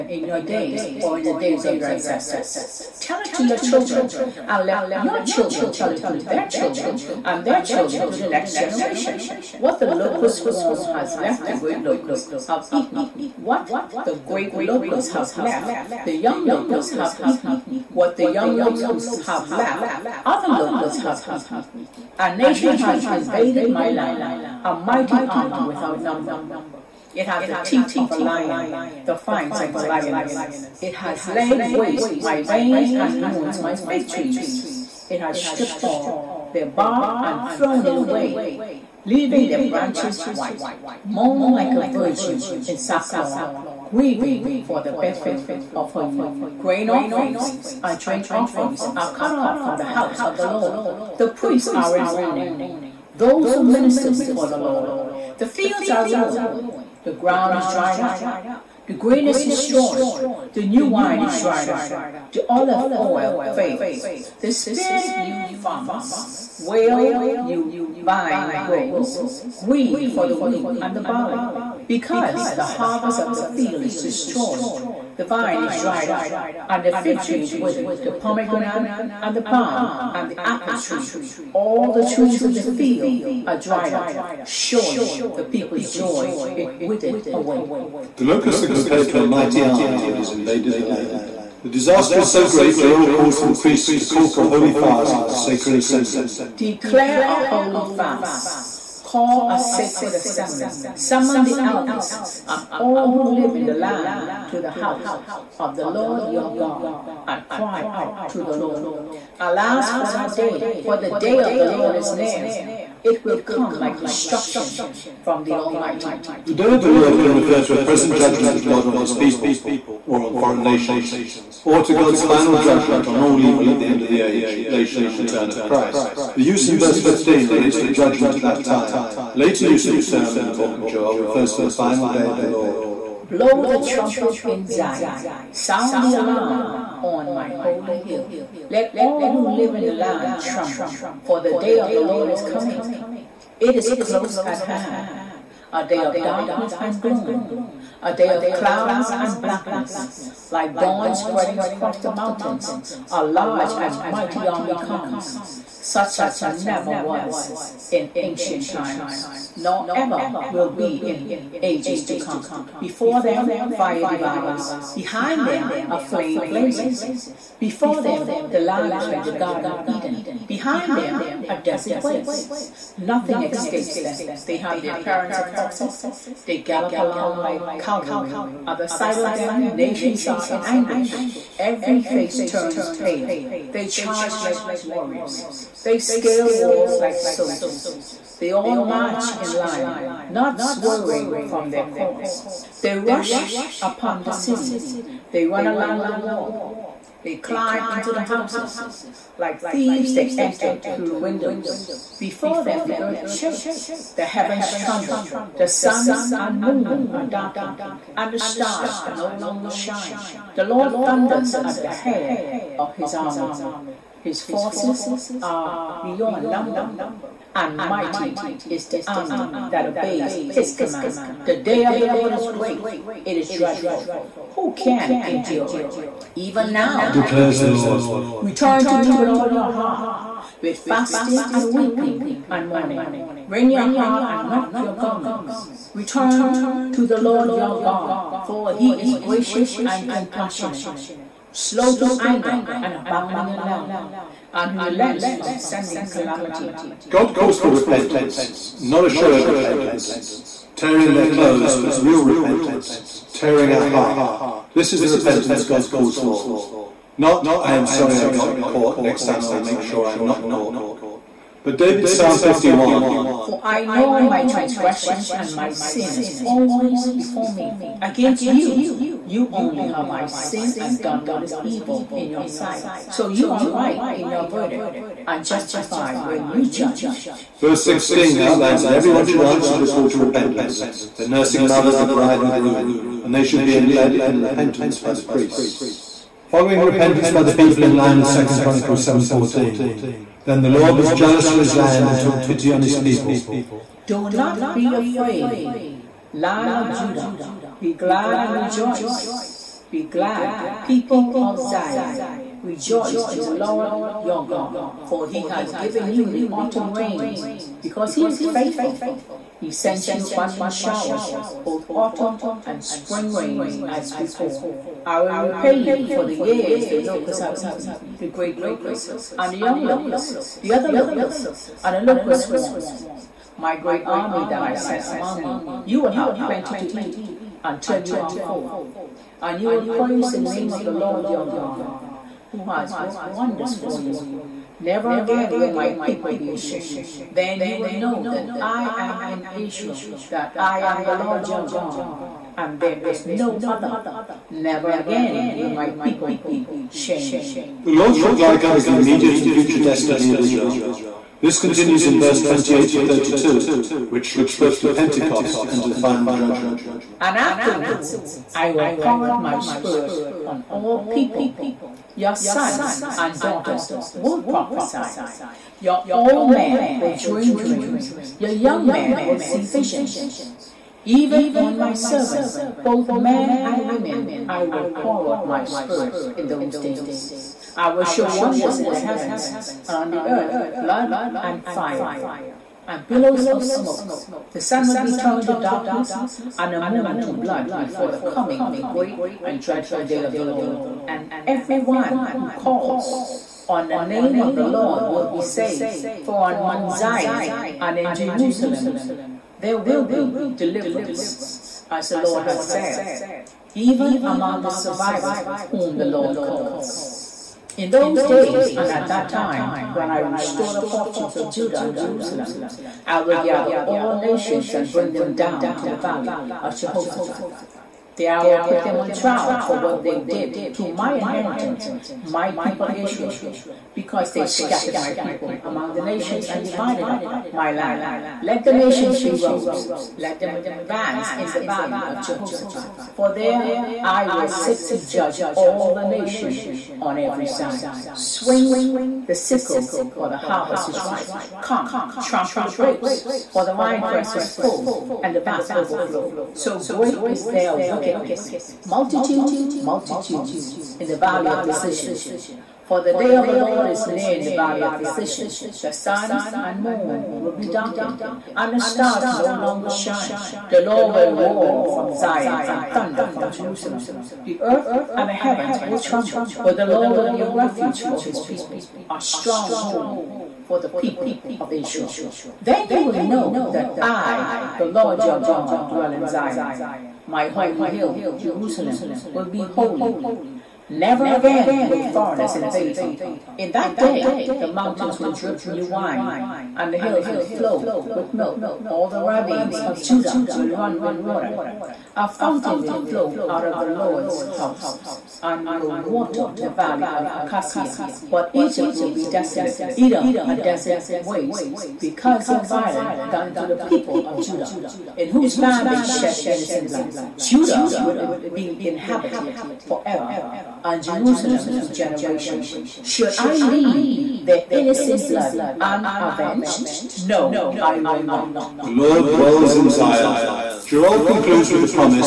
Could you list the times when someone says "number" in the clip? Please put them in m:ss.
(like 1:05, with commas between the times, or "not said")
0:26, 3:36.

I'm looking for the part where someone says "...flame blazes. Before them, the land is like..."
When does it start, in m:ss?
2:45.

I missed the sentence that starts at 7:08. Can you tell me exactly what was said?
Let the nations be rows, let them advance in the valley of Jehoshaphat.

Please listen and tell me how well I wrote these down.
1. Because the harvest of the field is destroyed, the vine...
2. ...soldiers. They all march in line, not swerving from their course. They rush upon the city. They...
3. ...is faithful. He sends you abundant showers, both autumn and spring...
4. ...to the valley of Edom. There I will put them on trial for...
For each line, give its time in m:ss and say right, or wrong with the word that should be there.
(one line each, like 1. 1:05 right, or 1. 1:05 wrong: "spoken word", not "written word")
1. 1:11 right
2. 3:07 right
3. 5:08 right
4. 6:55 wrong: "Jehoshaphat", not "Edom".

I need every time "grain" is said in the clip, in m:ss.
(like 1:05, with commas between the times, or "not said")
0:46, 0:58.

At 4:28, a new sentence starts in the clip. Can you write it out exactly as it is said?
Against you, you only have I sinned and done what is evil in your sight.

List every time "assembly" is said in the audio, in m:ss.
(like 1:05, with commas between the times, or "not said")
1:35, 1:40.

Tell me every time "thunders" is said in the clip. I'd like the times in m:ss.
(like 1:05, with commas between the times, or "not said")
3:31, 7:42.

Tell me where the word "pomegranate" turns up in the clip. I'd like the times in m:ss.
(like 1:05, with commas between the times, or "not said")
1:18.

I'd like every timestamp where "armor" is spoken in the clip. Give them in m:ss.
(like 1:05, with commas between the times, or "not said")
0:25.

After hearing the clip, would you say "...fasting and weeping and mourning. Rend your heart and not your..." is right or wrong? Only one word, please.
right.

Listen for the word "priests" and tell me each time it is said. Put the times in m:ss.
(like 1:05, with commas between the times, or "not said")
0:51, 1:33, 4:45.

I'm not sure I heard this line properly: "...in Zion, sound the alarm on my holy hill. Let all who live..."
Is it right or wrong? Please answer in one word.
right.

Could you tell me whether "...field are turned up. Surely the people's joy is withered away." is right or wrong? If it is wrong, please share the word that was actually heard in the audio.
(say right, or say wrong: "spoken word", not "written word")
wrong: "dried", not "turned".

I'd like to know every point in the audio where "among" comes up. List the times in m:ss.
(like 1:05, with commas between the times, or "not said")
5:25, 6:44, 7:05.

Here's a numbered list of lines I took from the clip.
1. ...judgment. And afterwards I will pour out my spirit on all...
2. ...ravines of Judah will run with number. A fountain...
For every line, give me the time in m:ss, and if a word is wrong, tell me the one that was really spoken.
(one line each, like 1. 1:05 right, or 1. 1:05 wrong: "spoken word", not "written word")
1. 5:56 right
2. 8:09 wrong: "water", not "number".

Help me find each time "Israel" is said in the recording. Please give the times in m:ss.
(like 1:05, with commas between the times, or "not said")
5:39, 5:50, 7:02, 7:51.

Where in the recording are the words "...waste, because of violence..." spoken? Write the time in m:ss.
8:21.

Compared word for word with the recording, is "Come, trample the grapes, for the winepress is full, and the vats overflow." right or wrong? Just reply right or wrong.
right.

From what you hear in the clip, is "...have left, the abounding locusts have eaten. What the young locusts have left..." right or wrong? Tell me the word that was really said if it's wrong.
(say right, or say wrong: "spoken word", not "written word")
wrong: "young", not "abounding".